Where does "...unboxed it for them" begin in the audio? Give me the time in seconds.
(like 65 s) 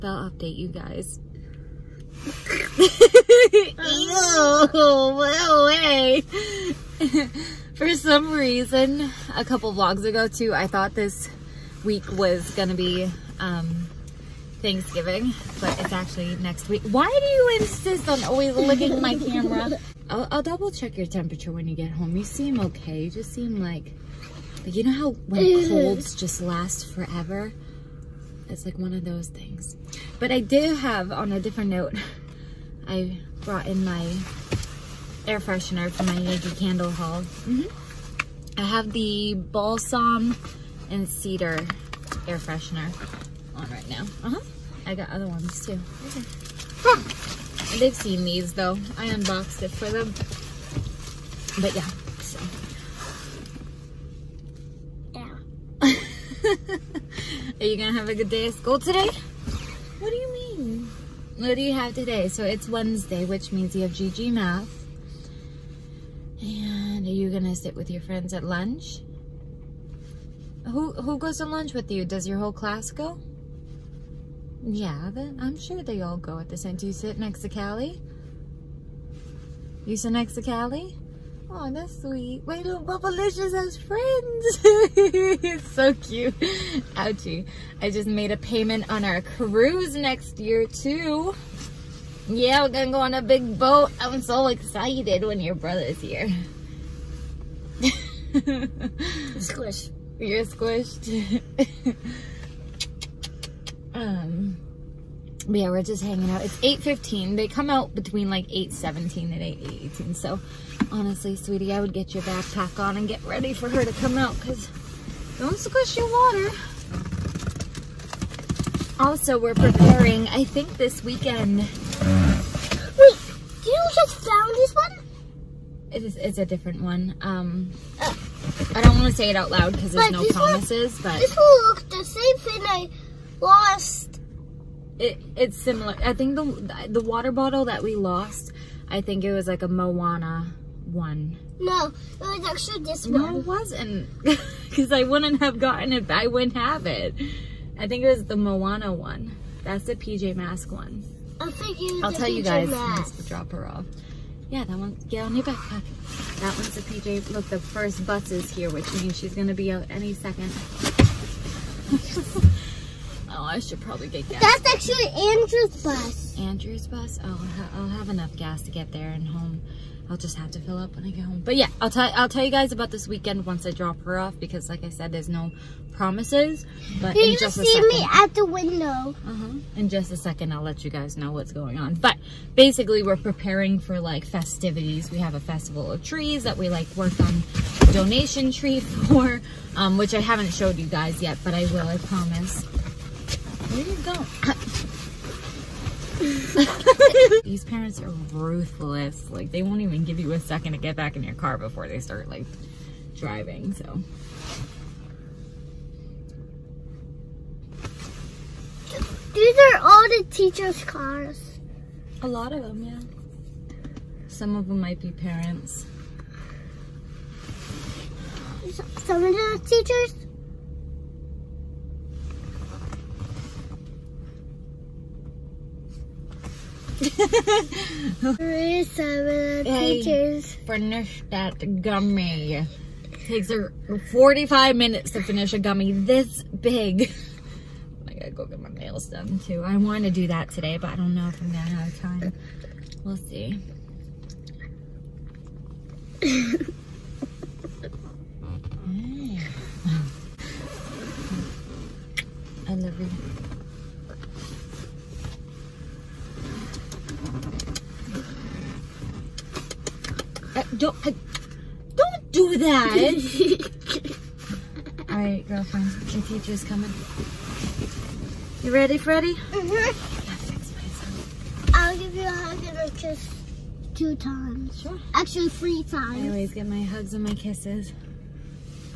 49 s.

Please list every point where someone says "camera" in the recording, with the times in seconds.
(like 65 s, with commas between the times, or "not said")
19 s.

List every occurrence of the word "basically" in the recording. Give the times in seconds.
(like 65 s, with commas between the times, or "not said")
182 s.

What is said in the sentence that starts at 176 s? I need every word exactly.
But Can in just a second, me at the window?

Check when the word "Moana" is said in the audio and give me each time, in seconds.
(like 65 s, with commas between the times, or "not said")
139 s, 148 s.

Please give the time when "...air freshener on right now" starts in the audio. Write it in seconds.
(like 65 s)
42 s.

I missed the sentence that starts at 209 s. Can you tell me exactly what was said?
These are all the teachers' cars.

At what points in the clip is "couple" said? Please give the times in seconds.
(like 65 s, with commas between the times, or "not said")
9 s.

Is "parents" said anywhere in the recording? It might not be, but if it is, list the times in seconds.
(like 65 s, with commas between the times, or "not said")
197 s, 215 s.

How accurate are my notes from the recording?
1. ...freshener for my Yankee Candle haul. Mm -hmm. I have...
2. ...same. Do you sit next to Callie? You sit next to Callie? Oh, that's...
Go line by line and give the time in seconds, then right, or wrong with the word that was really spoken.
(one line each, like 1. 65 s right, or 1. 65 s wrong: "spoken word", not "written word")
1. 35 s right
2. 76 s right.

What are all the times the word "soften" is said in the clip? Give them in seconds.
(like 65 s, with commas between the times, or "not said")
not said.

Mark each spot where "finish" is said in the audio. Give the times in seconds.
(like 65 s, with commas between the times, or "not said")
230 s, 235 s.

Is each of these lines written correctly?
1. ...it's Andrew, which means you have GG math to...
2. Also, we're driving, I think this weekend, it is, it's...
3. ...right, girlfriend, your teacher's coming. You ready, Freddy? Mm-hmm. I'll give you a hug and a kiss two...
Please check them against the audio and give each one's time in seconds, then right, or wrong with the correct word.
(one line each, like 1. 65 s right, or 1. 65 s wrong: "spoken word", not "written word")
1. 62 s wrong: "Wednesday", not "Andrew"
2. 118 s wrong: "preparing", not "driving"
3. 265 s right.